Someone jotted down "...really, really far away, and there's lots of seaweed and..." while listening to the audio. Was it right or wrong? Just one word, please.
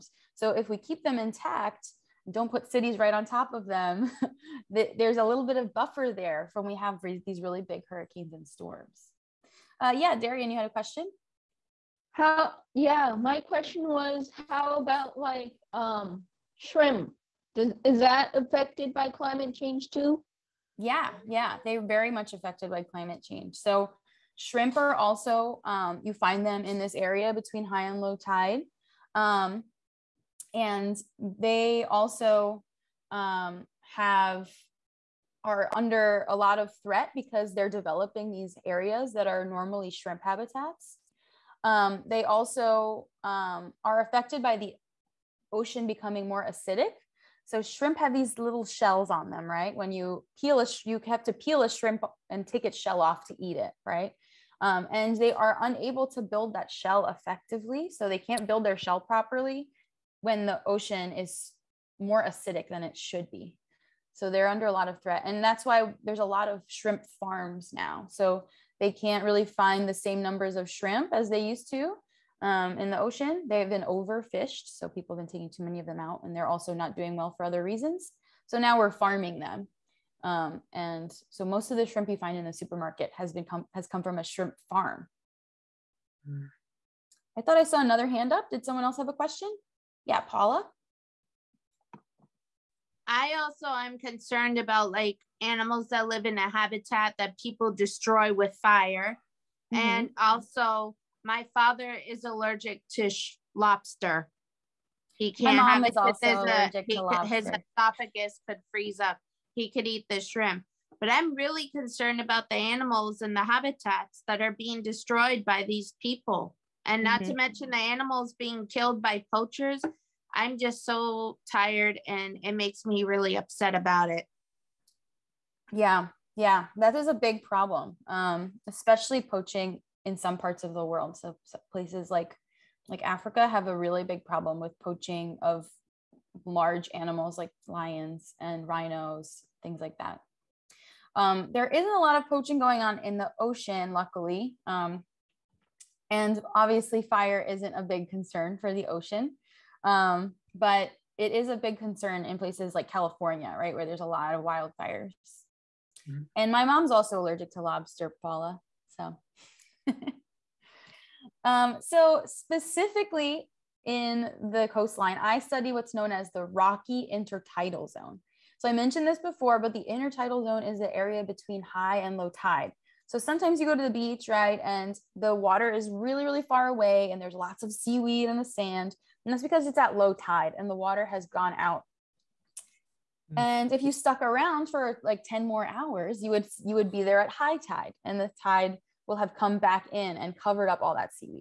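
right.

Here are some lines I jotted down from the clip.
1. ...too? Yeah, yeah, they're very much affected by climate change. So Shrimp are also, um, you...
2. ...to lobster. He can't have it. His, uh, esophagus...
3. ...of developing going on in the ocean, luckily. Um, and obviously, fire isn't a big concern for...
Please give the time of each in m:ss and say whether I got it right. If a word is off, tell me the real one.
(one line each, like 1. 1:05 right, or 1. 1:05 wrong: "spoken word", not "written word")
1. 0:19 right
2. 1:42 right
3. 2:22 wrong: "poaching", not "developing".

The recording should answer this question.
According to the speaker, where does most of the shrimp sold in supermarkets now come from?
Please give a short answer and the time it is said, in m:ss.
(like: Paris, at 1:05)
A shrimp farm, at 1:24.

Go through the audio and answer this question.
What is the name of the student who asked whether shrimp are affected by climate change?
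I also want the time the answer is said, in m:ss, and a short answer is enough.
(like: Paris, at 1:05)
Darian, at 0:10.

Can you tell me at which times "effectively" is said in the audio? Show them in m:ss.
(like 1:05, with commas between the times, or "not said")
0:57.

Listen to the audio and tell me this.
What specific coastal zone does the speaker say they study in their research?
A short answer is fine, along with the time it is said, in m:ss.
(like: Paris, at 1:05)
Rocky intertidal zone, at 2:46.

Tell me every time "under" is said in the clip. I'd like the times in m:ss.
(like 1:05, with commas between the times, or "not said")
0:35, 1:04.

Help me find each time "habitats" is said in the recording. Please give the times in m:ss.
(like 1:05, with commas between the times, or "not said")
0:40, 1:36, 1:53.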